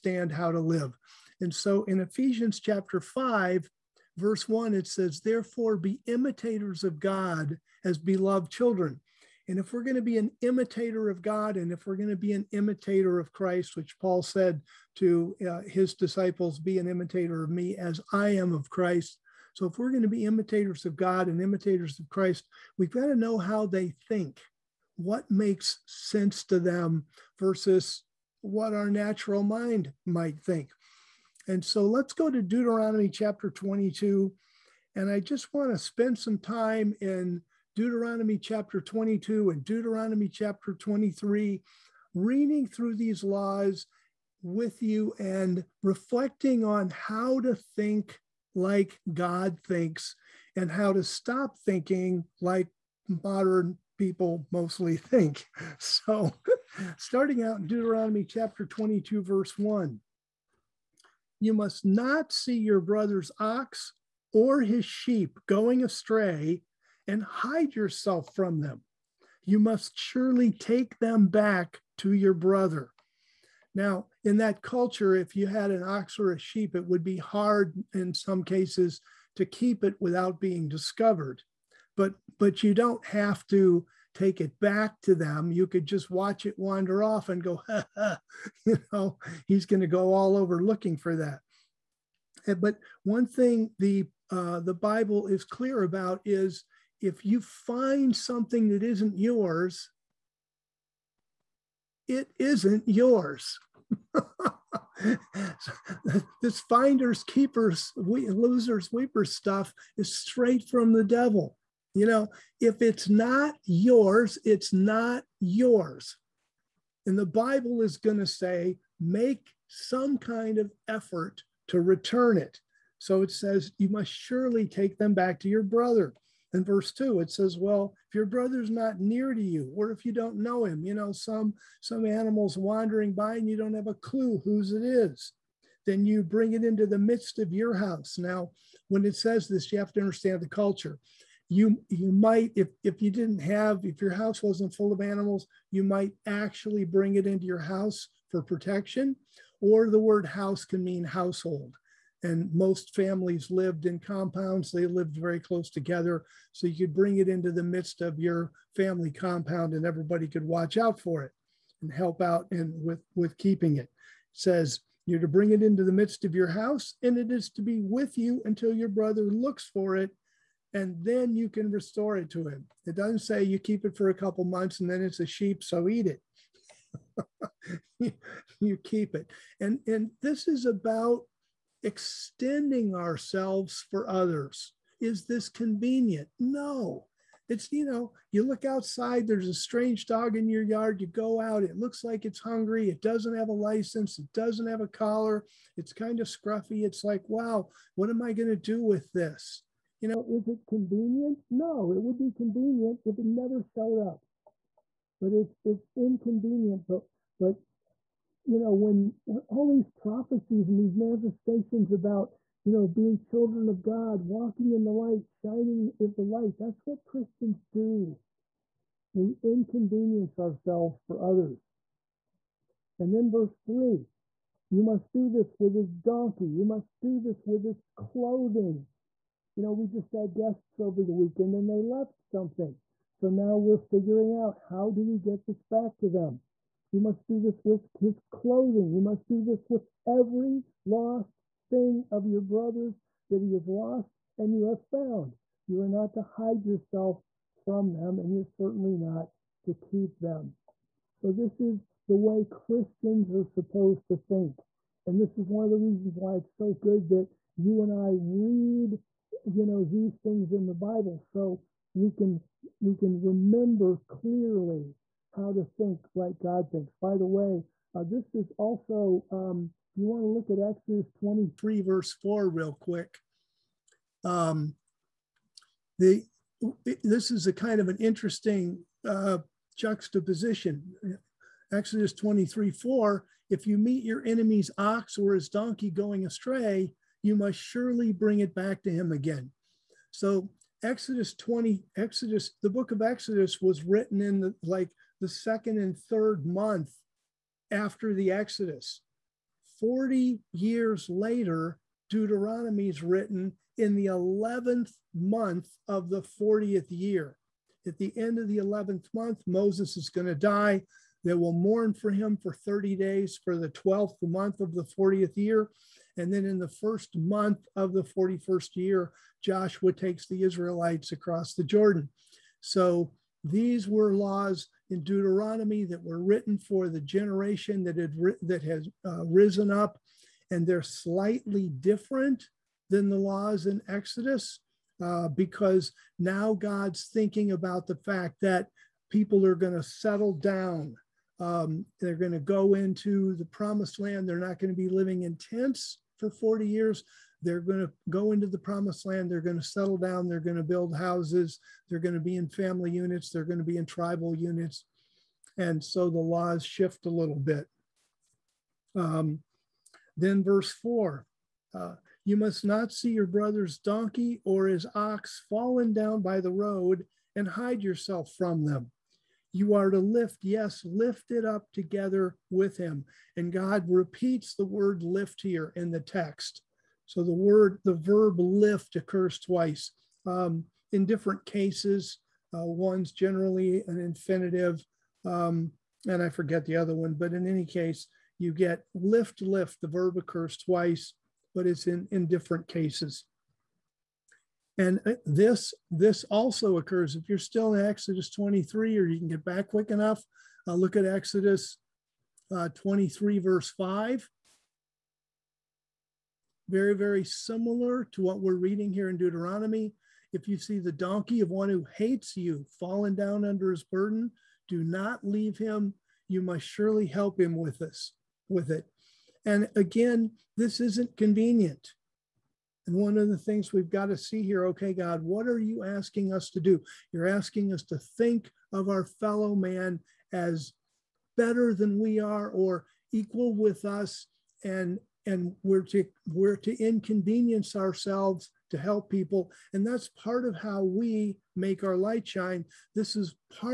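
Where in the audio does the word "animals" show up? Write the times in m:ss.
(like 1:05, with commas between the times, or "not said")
2:12, 2:25.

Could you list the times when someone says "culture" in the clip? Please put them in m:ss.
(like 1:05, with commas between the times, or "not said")
1:14, 2:20.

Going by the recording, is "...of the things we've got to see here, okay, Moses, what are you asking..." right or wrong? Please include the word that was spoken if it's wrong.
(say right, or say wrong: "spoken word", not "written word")
wrong: "God", not "Moses".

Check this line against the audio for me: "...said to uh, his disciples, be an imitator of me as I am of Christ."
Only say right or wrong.
right.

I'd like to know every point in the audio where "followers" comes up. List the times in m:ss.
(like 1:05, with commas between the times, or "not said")
not said.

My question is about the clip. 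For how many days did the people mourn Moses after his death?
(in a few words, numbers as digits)
30.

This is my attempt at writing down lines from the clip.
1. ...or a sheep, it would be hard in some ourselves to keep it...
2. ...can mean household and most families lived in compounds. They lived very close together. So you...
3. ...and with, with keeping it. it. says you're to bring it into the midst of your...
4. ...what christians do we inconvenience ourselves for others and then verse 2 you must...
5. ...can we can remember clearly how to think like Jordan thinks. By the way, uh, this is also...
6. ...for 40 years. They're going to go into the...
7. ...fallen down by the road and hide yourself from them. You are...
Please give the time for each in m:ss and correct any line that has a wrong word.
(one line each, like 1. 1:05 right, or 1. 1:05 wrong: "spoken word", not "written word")
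1. 1:16 wrong: "cases", not "ourselves"
2. 2:30 right
3. 2:42 right
4. 3:36 wrong: "3", not "2"
5. 4:22 wrong: "God", not "Jordan"
6. 5:46 right
7. 6:05 right.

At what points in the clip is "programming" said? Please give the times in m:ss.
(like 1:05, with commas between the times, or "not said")
not said.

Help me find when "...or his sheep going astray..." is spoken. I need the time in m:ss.
1:04.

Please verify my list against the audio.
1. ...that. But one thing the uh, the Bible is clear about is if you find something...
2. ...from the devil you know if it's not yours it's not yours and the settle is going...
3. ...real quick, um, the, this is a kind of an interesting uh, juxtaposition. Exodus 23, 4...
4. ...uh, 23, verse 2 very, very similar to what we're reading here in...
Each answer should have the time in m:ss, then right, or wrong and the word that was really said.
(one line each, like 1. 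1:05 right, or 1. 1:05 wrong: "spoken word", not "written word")
1. 1:31 right
2. 1:50 wrong: "bible", not "settle"
3. 4:32 right
4. 6:42 wrong: "5", not "2".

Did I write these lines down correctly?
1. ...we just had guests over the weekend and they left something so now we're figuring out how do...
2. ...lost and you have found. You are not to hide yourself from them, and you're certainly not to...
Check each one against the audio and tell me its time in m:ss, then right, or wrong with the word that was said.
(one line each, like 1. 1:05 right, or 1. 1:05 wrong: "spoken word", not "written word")
1. 3:49 right
2. 4:03 right.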